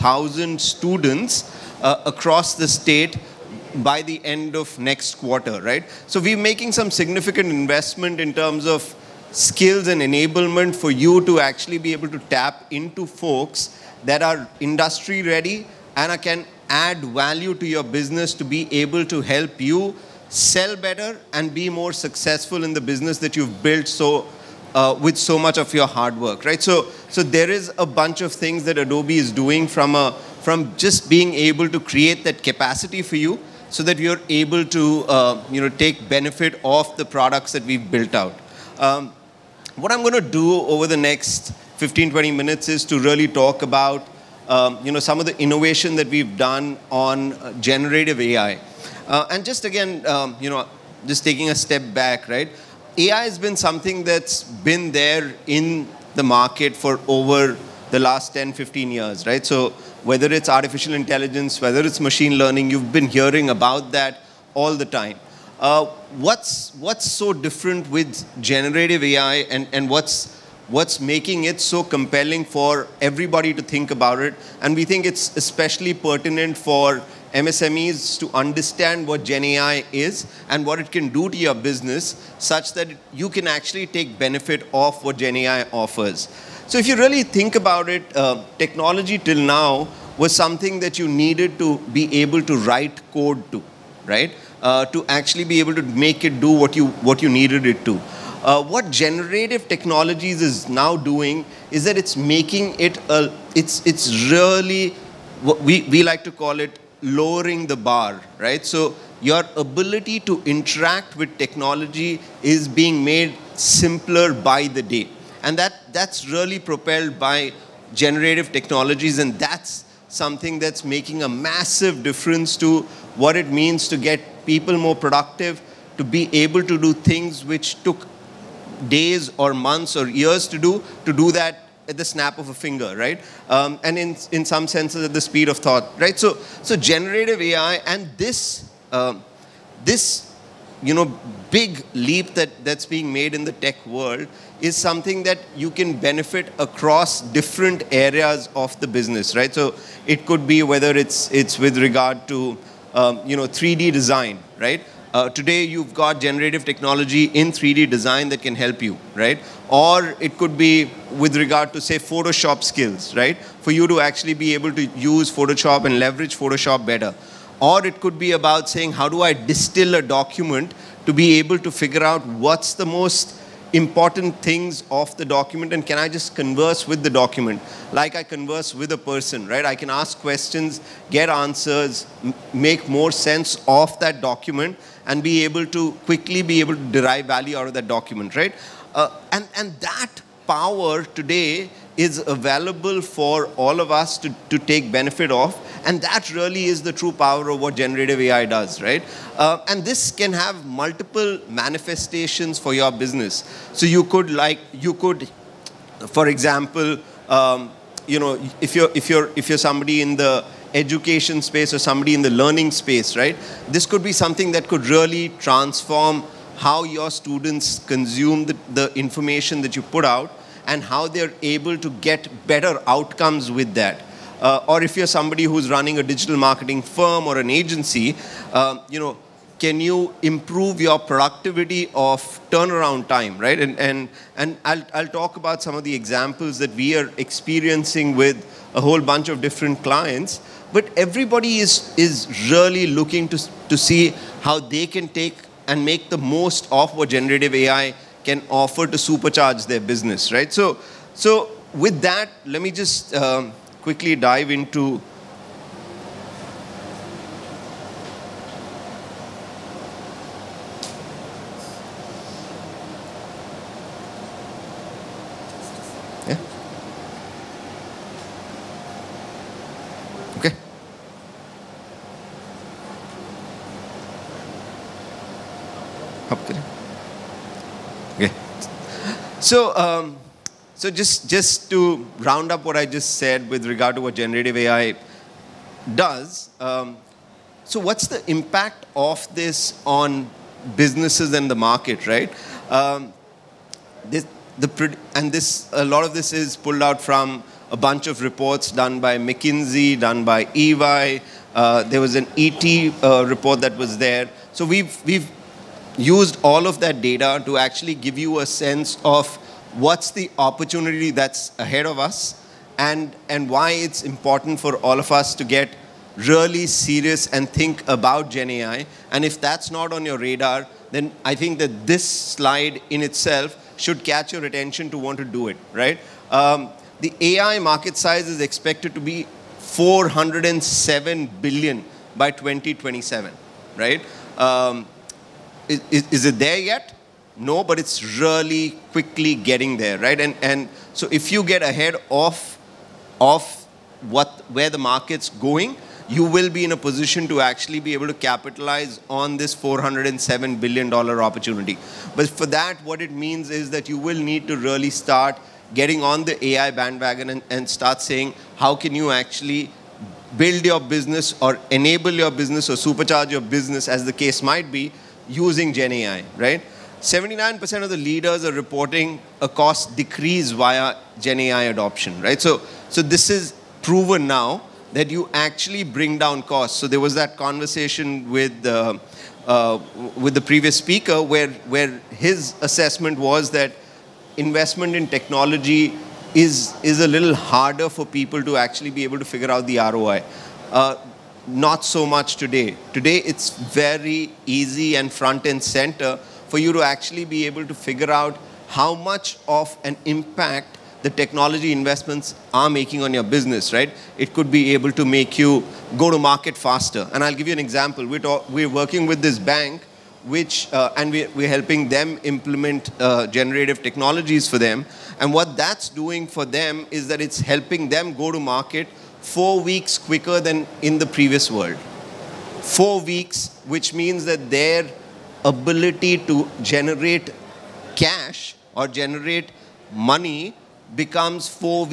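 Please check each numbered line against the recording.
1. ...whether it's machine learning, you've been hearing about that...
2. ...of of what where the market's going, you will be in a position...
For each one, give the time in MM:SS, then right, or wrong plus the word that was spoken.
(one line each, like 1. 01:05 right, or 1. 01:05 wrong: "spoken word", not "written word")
1. 01:01 right
2. 05:42 right.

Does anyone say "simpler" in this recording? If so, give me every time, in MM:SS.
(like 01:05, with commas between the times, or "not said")
01:53.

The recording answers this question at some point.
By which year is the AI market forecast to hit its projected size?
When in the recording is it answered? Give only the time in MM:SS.
05:32.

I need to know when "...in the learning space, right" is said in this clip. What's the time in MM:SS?
03:32.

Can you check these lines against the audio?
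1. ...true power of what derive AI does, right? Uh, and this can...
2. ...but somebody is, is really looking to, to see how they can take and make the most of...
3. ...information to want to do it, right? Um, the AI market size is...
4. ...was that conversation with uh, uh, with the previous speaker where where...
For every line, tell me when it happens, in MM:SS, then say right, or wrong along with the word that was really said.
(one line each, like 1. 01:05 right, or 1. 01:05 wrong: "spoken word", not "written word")
1. 03:16 wrong: "generative", not "derive"
2. 04:00 wrong: "everybody", not "somebody"
3. 05:24 wrong: "attention", not "information"
4. 06:16 right.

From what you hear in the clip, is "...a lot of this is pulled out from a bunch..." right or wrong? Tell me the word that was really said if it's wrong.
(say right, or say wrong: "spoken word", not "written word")
right.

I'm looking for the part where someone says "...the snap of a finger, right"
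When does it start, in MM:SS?
02:11.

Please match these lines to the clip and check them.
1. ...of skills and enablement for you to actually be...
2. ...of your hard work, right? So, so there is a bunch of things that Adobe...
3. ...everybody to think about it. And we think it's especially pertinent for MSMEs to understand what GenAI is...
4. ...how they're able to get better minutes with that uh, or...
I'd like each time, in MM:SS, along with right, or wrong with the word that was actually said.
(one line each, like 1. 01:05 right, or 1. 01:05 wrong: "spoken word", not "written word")
1. 00:08 right
2. 00:25 right
3. 01:13 right
4. 03:40 wrong: "outcomes", not "minutes".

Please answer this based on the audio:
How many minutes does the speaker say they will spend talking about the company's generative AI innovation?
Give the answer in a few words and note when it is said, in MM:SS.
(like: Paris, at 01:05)
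15 to 20 minutes, at 00:41.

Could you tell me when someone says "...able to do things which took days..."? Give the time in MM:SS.
02:06.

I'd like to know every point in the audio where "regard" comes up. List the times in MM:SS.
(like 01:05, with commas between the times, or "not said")
02:31, 02:41, 04:43.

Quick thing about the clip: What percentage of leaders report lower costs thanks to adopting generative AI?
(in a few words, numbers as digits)
79%.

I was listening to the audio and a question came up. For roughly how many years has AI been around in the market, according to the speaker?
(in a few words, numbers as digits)
10 to 15 years.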